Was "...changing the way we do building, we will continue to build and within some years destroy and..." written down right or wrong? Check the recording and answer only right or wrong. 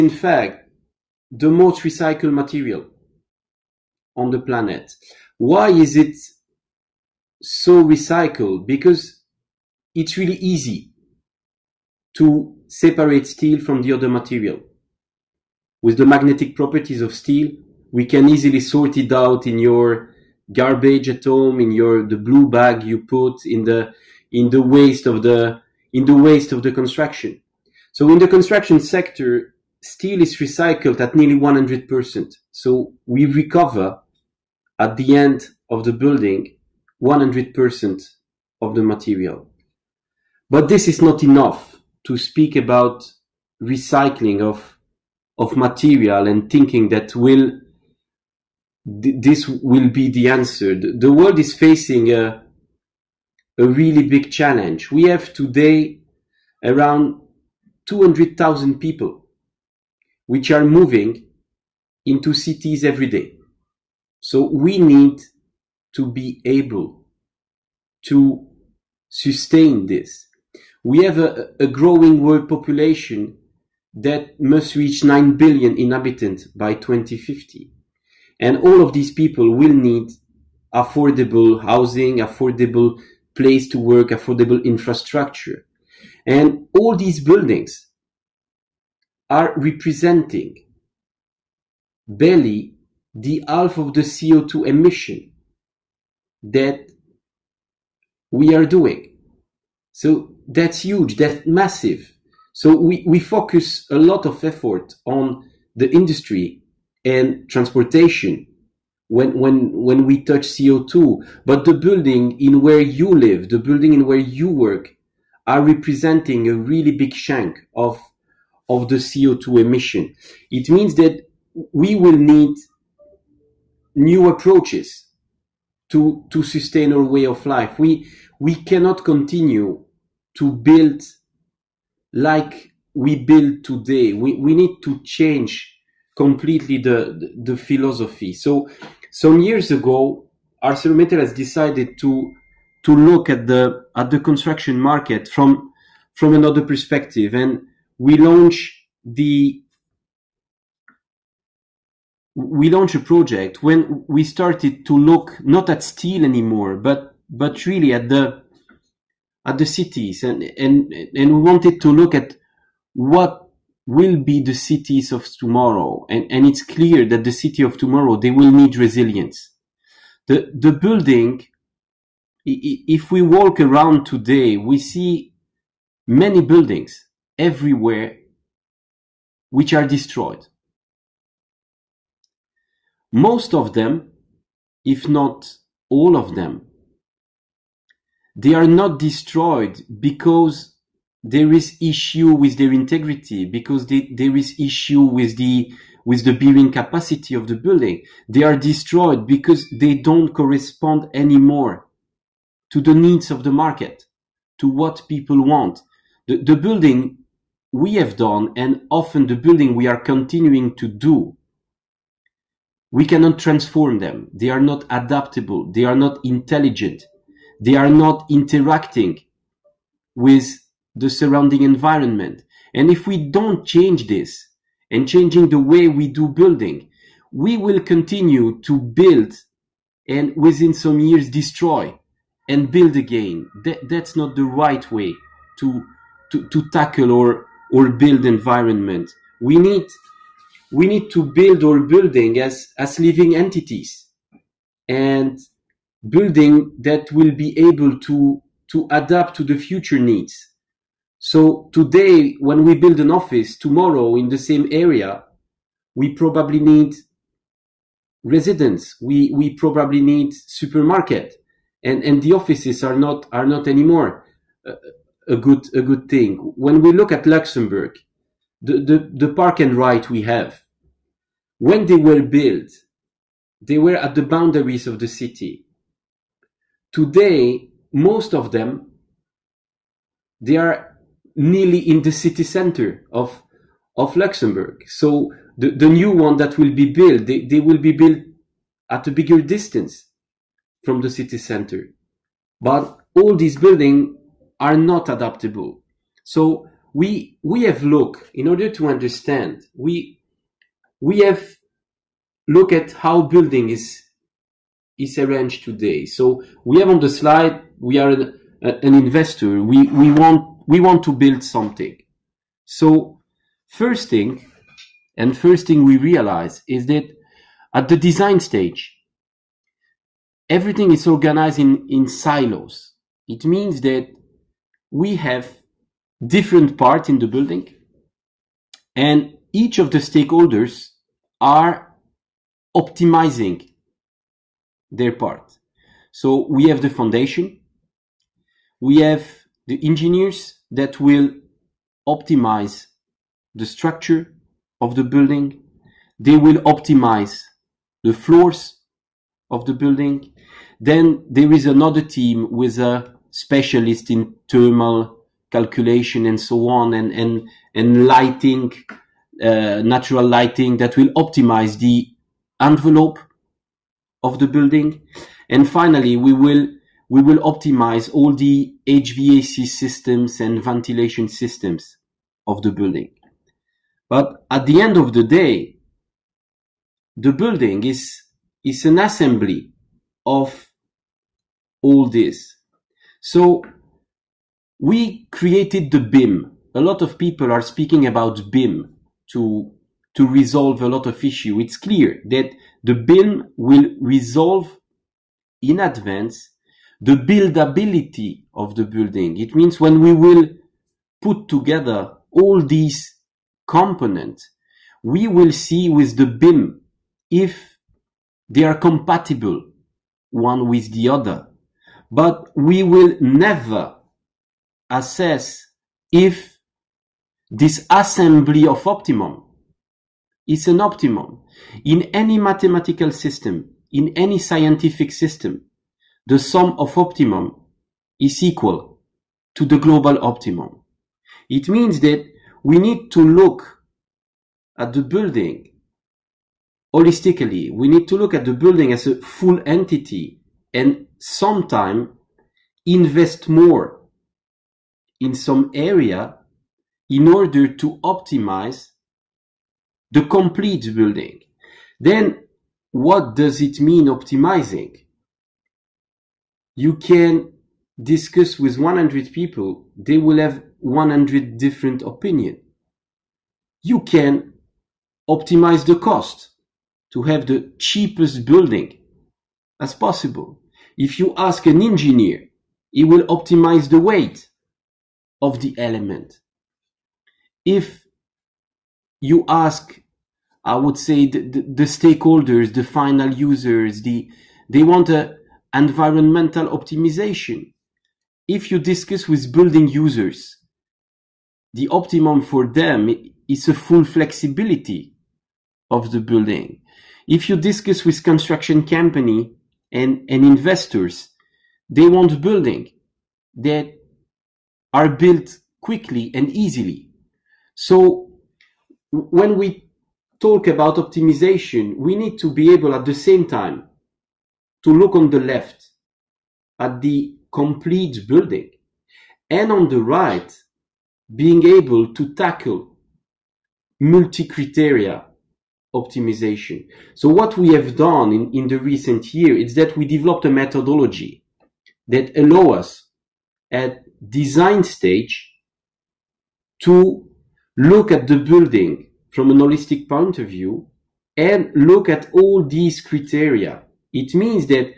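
right.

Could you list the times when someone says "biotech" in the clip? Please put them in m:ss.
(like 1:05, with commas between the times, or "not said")
not said.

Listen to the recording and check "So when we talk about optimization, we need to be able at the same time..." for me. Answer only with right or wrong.
right.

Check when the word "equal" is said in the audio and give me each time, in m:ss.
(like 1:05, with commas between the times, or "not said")
7:08.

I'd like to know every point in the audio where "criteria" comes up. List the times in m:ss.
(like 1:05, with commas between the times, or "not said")
8:44, 9:03.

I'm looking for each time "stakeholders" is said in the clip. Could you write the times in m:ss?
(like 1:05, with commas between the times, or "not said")
5:29, 8:01.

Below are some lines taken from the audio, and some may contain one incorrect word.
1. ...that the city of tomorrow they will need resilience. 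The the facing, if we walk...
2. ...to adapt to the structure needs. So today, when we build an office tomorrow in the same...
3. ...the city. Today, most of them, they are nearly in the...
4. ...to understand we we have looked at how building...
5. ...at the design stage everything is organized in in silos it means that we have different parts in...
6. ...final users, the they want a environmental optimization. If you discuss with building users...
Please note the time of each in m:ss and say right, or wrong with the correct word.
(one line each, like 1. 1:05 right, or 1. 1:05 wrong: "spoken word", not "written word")
1. 2:47 wrong: "building", not "facing"
2. 4:08 wrong: "future", not "structure"
3. 4:34 right
4. 4:58 right
5. 5:17 right
6. 8:02 right.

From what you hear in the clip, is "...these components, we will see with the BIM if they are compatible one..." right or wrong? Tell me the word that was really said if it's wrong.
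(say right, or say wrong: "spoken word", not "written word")
right.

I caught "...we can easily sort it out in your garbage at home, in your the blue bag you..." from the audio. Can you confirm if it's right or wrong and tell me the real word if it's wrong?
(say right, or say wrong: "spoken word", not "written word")
right.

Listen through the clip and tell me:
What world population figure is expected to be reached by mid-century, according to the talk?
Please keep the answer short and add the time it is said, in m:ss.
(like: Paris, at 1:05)
9 billion, at 1:15.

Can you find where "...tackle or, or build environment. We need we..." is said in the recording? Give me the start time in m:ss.
3:56.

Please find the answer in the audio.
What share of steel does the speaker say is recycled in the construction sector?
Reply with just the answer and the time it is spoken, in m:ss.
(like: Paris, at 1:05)
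nearly 100%, at 0:31.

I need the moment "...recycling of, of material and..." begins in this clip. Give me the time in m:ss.
0:43.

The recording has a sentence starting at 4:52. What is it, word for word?
But all these buildings are not adaptable.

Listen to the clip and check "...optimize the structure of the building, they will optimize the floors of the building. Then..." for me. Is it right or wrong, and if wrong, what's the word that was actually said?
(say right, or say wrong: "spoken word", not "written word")
right.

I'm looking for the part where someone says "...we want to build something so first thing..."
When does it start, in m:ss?
5:10.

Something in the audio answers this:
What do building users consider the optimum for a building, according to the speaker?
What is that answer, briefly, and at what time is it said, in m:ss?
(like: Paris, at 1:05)
full flexibility, at 8:13.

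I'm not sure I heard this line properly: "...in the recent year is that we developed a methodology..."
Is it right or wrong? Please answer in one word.
right.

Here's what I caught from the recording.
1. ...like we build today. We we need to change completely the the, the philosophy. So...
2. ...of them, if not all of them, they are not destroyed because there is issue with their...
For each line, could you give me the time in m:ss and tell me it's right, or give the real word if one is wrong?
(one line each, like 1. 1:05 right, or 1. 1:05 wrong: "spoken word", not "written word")
1. 2:12 right
2. 3:03 right.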